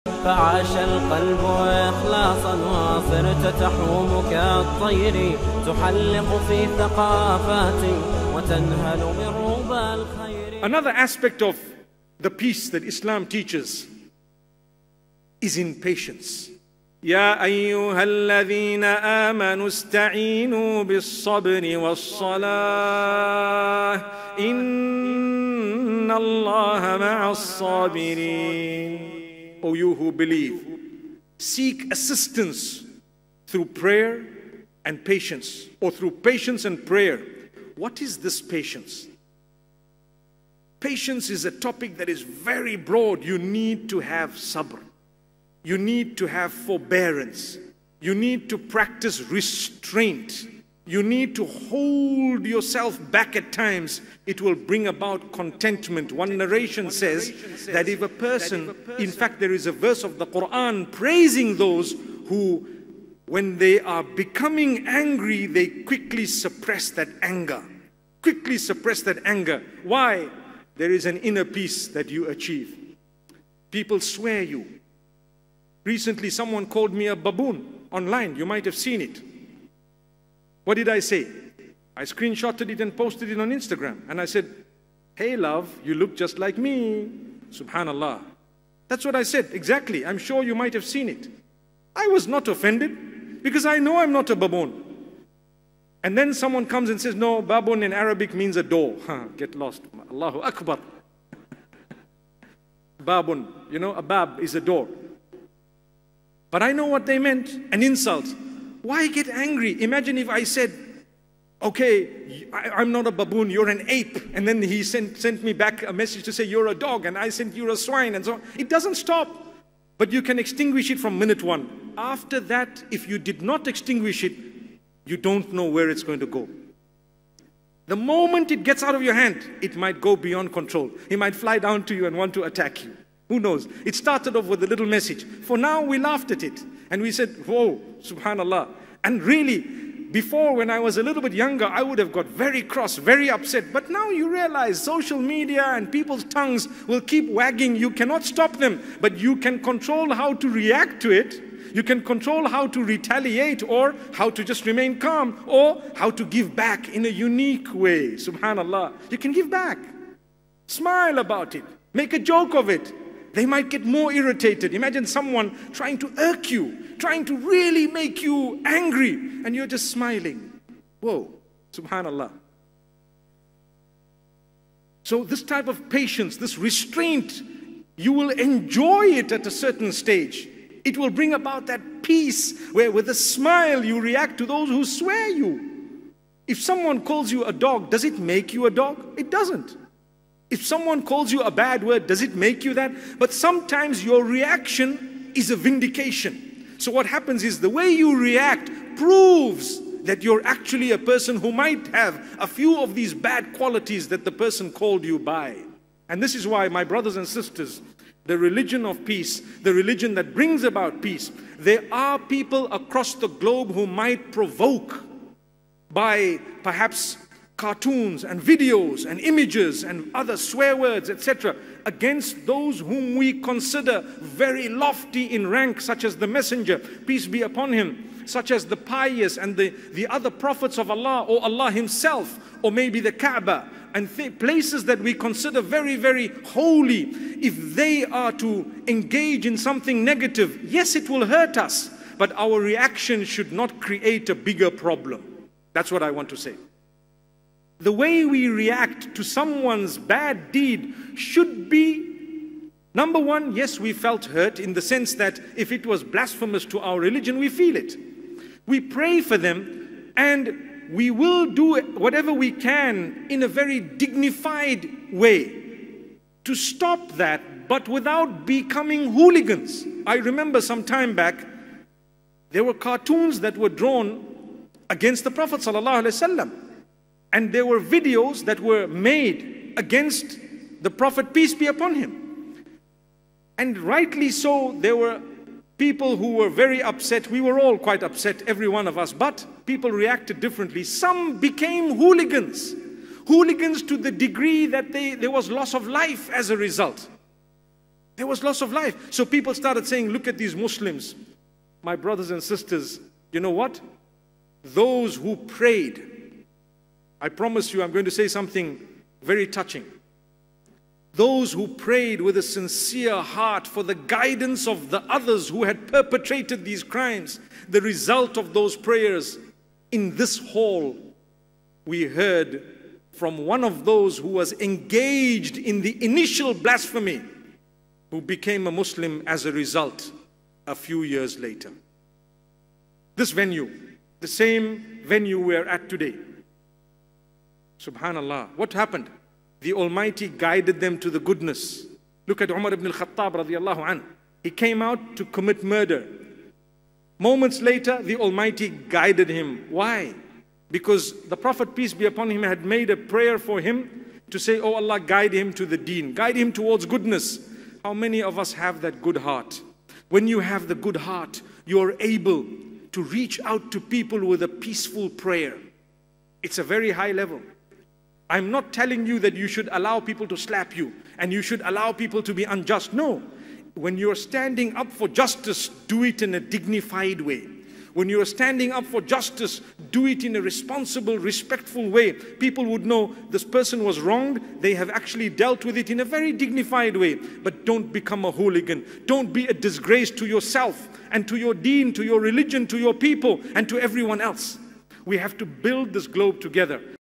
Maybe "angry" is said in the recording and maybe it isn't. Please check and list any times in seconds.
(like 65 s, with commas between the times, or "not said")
64 s, 109 s, 168 s.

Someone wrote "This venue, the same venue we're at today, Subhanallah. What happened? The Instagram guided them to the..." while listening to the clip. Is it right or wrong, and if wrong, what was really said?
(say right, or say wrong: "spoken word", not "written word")
wrong: "Almighty", not "Instagram".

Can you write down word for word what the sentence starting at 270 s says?
I remember some time back, there were cartoons that were drawn against the Prophet.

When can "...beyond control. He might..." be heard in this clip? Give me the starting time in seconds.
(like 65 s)
130 s.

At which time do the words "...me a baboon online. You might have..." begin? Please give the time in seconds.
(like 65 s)
76 s.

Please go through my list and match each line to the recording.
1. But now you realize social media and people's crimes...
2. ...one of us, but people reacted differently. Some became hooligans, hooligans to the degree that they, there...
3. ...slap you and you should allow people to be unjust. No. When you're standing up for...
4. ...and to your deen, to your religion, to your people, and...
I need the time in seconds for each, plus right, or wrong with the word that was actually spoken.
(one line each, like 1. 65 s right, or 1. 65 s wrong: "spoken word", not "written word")
1. 143 s wrong: "tongues", not "crimes"
2. 288 s right
3. 370 s right
4. 391 s right.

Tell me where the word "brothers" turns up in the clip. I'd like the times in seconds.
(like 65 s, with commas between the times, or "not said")
206 s, 301 s.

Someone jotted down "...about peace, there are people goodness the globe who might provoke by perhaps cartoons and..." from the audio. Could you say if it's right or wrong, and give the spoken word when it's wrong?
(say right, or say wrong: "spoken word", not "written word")
wrong: "across", not "goodness".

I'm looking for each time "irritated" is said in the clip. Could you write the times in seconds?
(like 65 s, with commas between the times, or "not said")
164 s.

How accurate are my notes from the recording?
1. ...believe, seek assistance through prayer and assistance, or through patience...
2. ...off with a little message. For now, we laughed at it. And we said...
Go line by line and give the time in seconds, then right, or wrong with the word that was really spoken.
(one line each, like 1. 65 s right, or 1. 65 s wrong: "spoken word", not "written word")
1. 30 s wrong: "patience", not "assistance"
2. 134 s right.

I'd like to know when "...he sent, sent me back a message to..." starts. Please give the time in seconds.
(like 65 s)
114 s.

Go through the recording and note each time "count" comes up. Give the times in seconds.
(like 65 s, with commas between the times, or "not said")
not said.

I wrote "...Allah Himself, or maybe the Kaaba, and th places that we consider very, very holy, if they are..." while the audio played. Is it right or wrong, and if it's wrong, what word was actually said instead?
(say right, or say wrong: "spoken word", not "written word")
right.